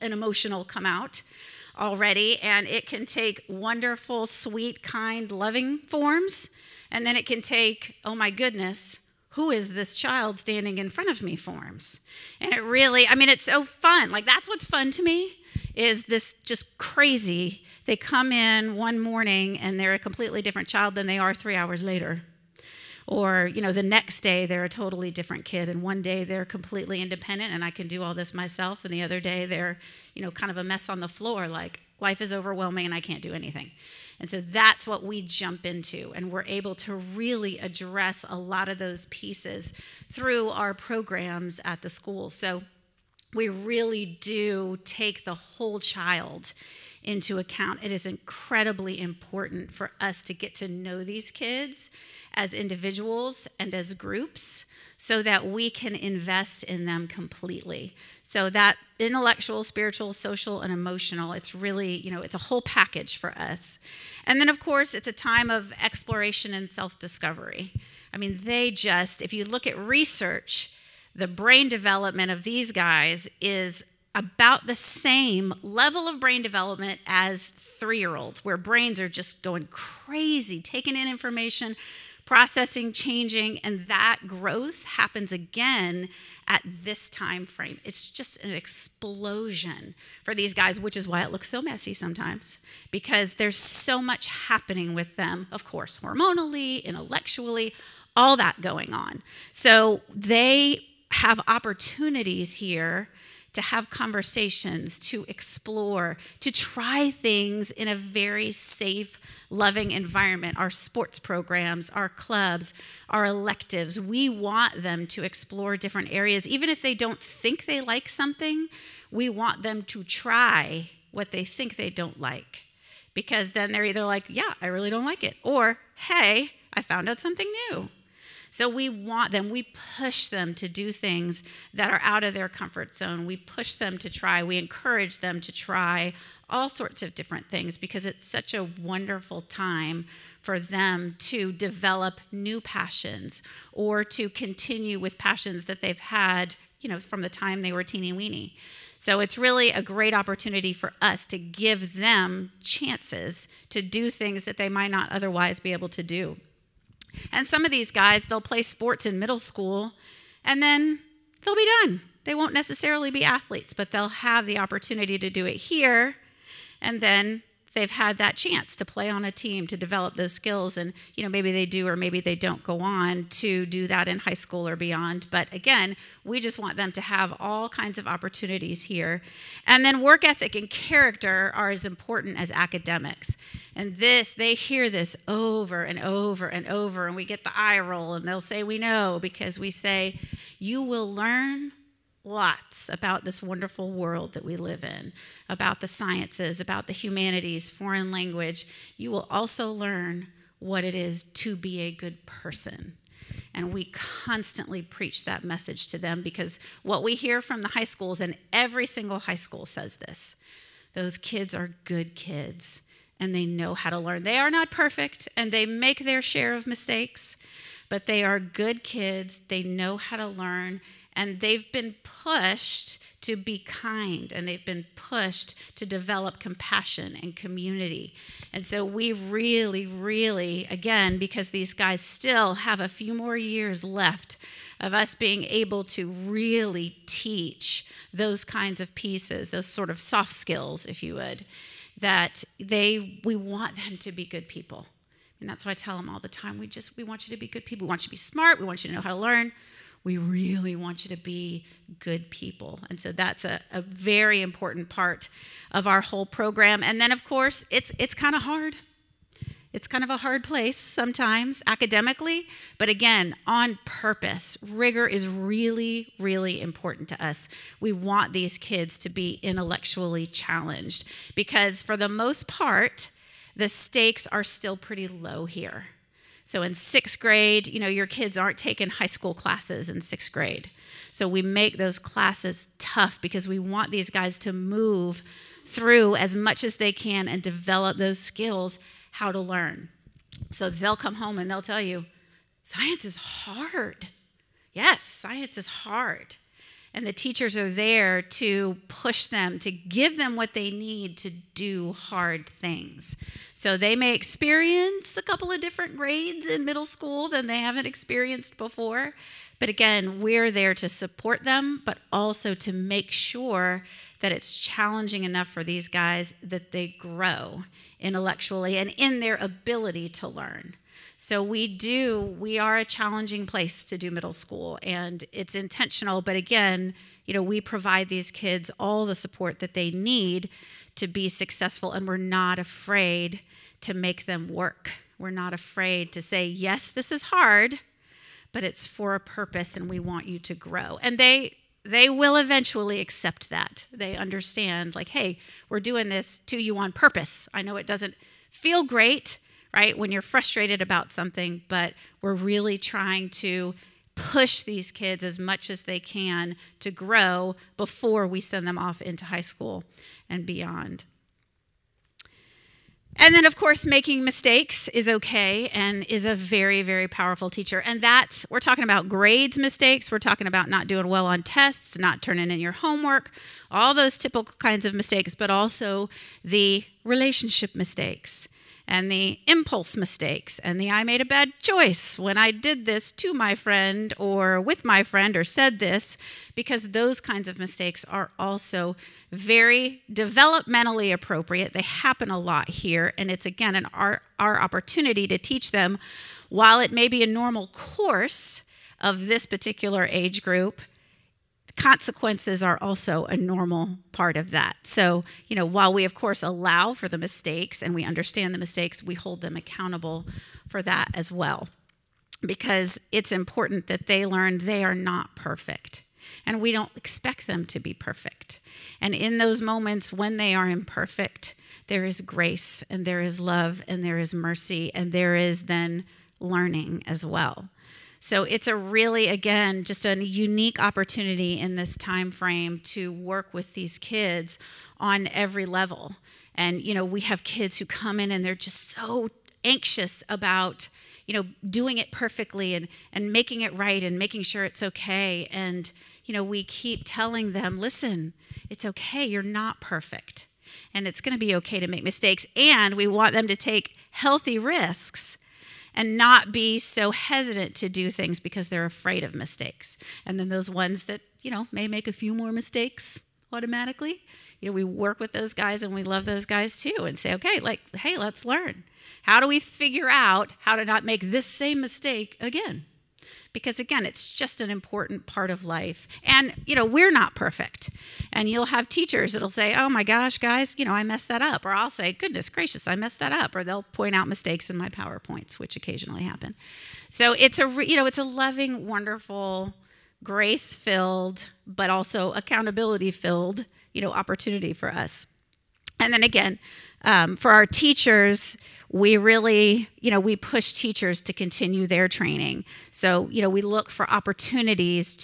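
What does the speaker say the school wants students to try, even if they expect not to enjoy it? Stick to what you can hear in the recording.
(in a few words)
what they think they don't like.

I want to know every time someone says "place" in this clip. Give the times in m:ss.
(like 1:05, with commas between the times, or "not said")
4:20, 5:23.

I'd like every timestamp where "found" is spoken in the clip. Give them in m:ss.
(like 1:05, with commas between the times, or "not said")
2:06.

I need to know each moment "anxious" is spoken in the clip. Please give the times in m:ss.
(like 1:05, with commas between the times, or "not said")
7:19.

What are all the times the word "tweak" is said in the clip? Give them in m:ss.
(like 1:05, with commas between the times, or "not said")
not said.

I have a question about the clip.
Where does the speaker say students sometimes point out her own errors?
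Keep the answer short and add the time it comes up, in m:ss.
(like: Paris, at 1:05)
PowerPoints, at 8:04.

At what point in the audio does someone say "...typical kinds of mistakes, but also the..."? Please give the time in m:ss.
6:14.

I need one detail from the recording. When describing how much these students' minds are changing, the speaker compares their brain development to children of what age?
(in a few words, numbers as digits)
3 year olds.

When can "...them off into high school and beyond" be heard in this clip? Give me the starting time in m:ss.
5:58.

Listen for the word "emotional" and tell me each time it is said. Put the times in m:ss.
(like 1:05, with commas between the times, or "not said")
0:00, 1:00.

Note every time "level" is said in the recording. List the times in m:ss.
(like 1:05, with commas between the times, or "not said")
1:15, 7:15.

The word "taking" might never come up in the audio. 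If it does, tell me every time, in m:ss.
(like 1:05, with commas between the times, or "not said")
1:20, 4:38.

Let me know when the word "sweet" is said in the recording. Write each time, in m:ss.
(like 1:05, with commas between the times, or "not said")
0:04.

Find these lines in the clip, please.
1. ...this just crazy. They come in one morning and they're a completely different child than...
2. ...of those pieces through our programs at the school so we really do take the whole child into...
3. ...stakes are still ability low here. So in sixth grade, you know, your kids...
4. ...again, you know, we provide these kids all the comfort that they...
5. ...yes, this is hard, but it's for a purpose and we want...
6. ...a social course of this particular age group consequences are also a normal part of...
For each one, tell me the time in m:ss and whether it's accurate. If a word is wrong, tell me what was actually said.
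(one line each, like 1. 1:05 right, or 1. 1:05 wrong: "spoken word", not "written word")
1. 0:16 right
2. 0:38 right
3. 4:33 wrong: "pretty", not "ability"
4. 5:26 wrong: "support", not "comfort"
5. 5:36 right
6. 6:37 wrong: "normal", not "social".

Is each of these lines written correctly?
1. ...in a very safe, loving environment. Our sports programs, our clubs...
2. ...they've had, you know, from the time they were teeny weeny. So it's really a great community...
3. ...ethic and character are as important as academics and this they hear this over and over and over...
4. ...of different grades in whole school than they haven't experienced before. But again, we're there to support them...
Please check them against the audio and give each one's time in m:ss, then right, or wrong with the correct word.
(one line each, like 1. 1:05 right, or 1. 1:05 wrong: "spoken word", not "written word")
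1. 1:47 right
2. 2:25 wrong: "opportunity", not "community"
3. 3:00 right
4. 5:05 wrong: "middle", not "whole".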